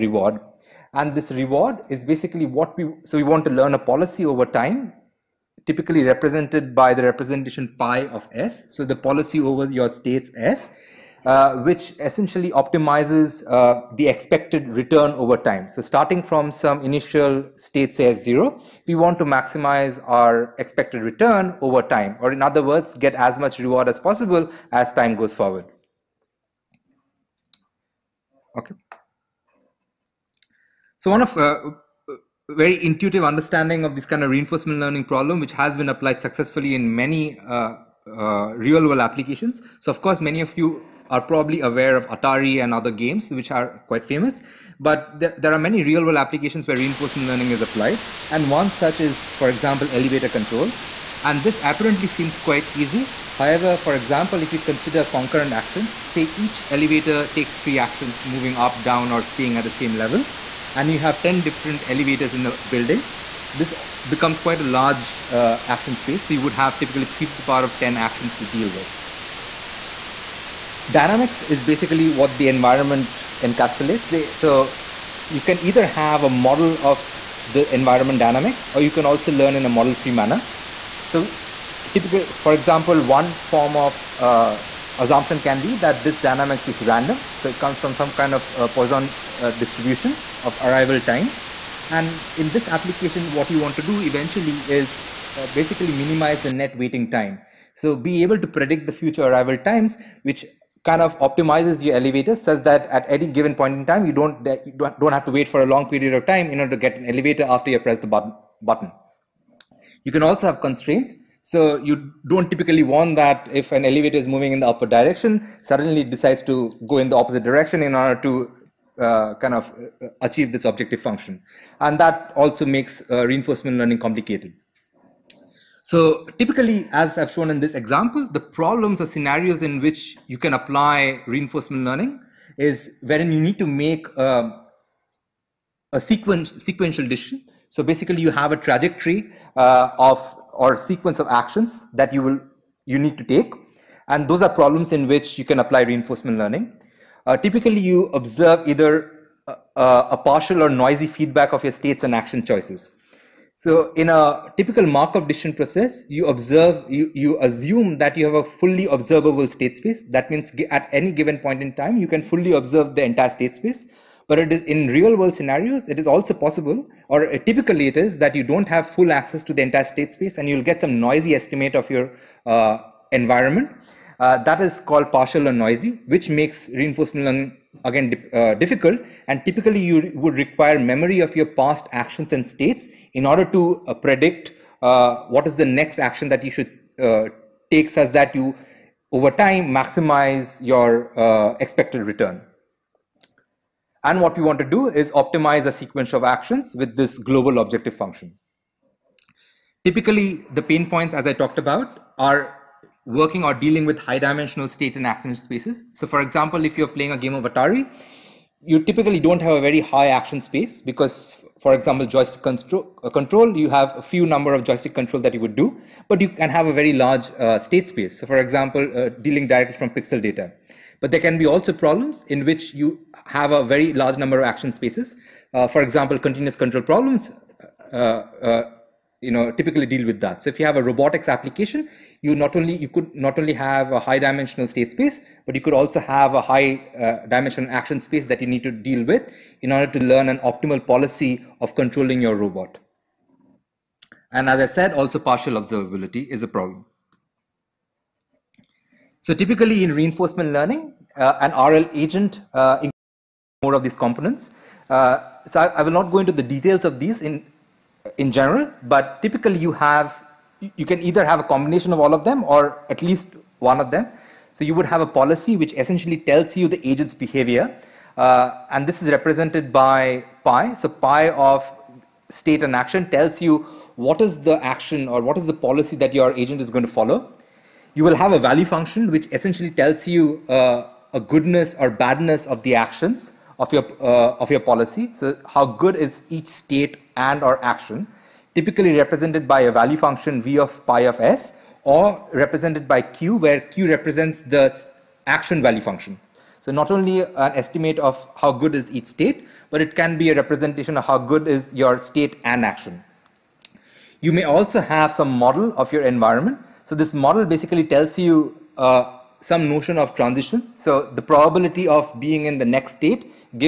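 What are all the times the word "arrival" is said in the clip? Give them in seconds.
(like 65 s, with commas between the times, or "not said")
90 s, 99 s.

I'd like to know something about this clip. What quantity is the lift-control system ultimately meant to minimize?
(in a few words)
Net waiting time.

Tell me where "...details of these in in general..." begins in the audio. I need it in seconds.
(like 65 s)
256 s.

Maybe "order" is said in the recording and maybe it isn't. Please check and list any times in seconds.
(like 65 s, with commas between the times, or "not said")
106 s, 117 s, 183 s, 239 s.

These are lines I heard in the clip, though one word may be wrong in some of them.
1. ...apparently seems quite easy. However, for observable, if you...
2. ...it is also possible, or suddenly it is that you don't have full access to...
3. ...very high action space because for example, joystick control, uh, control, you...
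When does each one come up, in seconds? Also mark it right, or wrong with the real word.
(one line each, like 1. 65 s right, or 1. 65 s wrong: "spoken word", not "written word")
1. 51 s wrong: "example", not "observable"
2. 165 s wrong: "typically", not "suddenly"
3. 209 s right.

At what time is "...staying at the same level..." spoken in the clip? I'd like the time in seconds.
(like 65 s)
59 s.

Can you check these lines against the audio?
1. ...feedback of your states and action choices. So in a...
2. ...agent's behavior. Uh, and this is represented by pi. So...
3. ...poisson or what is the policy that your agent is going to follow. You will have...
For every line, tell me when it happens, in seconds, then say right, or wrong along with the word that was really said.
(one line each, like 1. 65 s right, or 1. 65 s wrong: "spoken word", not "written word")
1. 151 s right
2. 266 s right
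3. 274 s wrong: "action", not "poisson".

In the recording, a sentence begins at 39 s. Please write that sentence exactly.
So, of course, many of you are probably aware of Atari and other games, which are quite famous.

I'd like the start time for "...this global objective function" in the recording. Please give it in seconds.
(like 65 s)
196 s.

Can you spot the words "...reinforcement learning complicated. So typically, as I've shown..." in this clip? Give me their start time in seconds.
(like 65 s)
123 s.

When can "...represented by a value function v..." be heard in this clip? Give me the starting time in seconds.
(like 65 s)
288 s.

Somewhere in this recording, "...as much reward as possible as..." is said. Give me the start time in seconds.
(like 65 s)
23 s.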